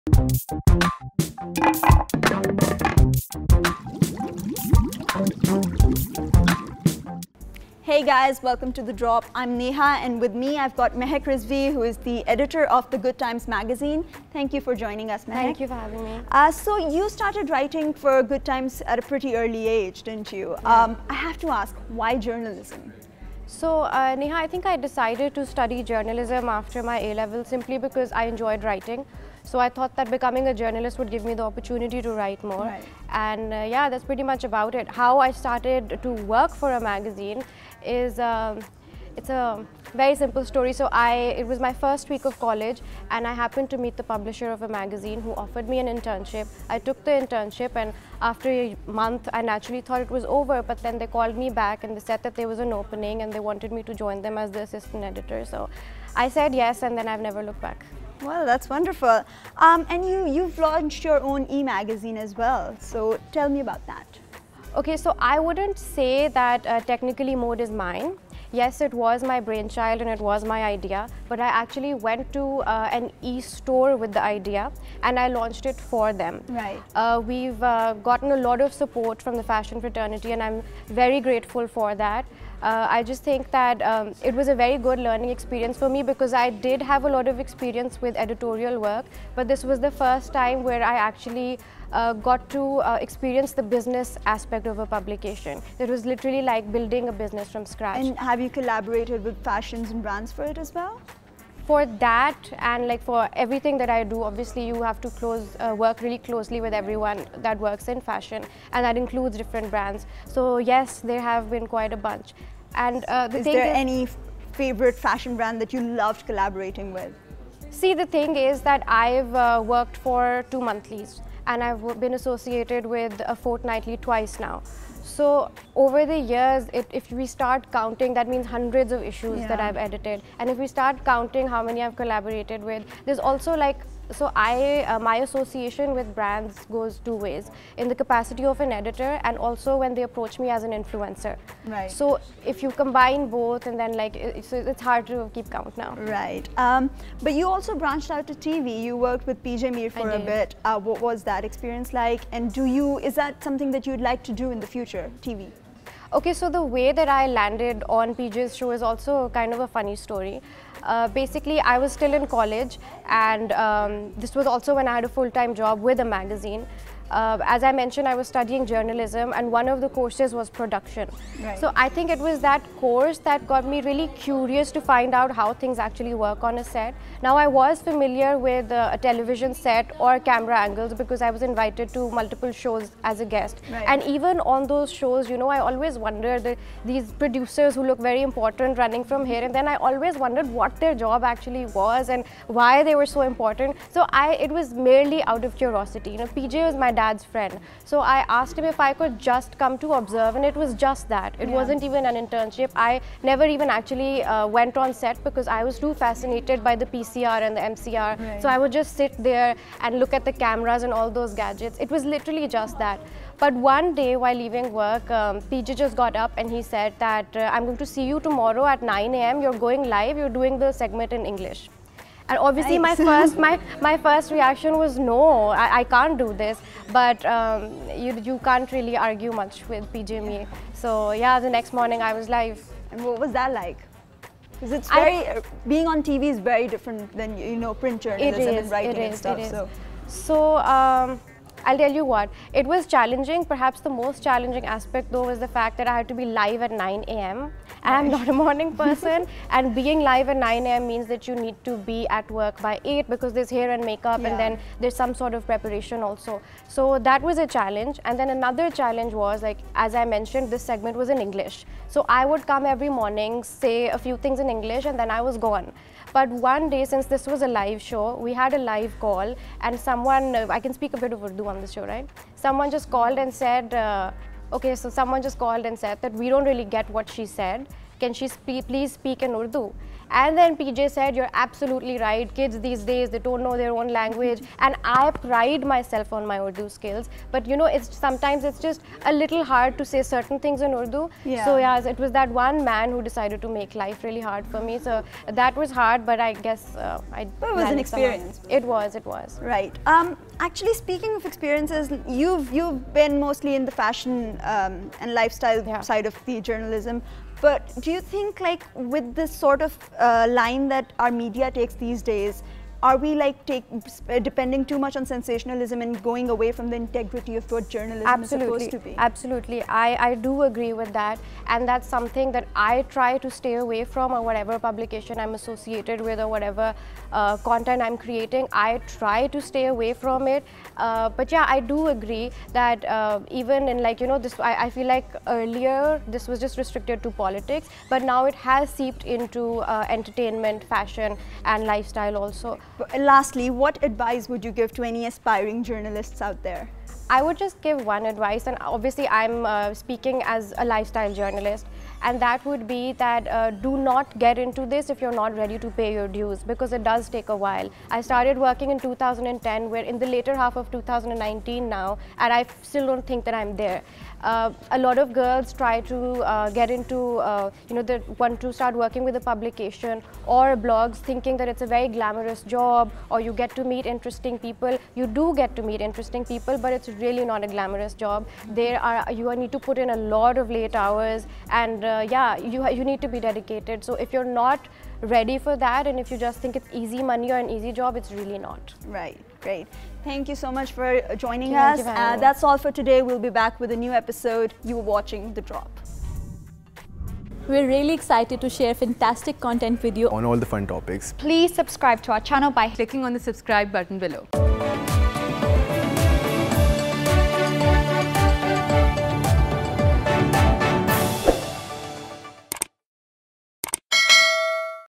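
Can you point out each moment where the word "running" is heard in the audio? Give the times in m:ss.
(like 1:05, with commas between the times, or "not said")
3:08.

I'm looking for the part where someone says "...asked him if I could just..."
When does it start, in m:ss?
3:18.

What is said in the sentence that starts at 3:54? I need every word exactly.
Because it's very I, being on TV is very different than you know print journalism is, and writing is, and stuff.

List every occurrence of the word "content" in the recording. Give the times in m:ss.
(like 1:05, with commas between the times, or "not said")
5:27, 6:39.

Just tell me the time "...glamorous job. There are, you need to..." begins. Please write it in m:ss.
6:17.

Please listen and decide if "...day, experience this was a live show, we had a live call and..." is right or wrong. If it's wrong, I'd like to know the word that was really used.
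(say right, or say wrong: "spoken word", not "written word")
wrong: "since", not "experience".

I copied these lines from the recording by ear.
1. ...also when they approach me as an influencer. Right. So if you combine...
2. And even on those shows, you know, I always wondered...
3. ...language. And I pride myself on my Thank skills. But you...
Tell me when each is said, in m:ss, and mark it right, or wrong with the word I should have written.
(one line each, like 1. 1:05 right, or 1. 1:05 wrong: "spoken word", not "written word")
1. 2:19 right
2. 3:03 right
3. 4:43 wrong: "Urdu", not "Thank".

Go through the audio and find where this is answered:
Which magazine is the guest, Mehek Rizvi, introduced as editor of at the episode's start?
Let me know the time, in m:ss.
0:12.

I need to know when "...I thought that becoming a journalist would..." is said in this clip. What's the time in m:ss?
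0:29.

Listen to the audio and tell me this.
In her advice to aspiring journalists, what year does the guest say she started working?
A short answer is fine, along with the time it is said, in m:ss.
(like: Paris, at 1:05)
2010, at 5:58.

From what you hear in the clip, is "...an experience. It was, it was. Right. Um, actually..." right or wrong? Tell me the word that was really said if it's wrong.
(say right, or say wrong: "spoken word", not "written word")
right.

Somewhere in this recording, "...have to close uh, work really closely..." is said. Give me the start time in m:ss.
1:44.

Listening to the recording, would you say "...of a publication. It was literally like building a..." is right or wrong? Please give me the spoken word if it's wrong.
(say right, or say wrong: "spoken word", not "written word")
right.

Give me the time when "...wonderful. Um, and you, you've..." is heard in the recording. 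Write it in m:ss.
0:58.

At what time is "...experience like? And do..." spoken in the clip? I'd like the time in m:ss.
2:31.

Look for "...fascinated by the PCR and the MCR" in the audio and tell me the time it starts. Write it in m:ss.
3:26.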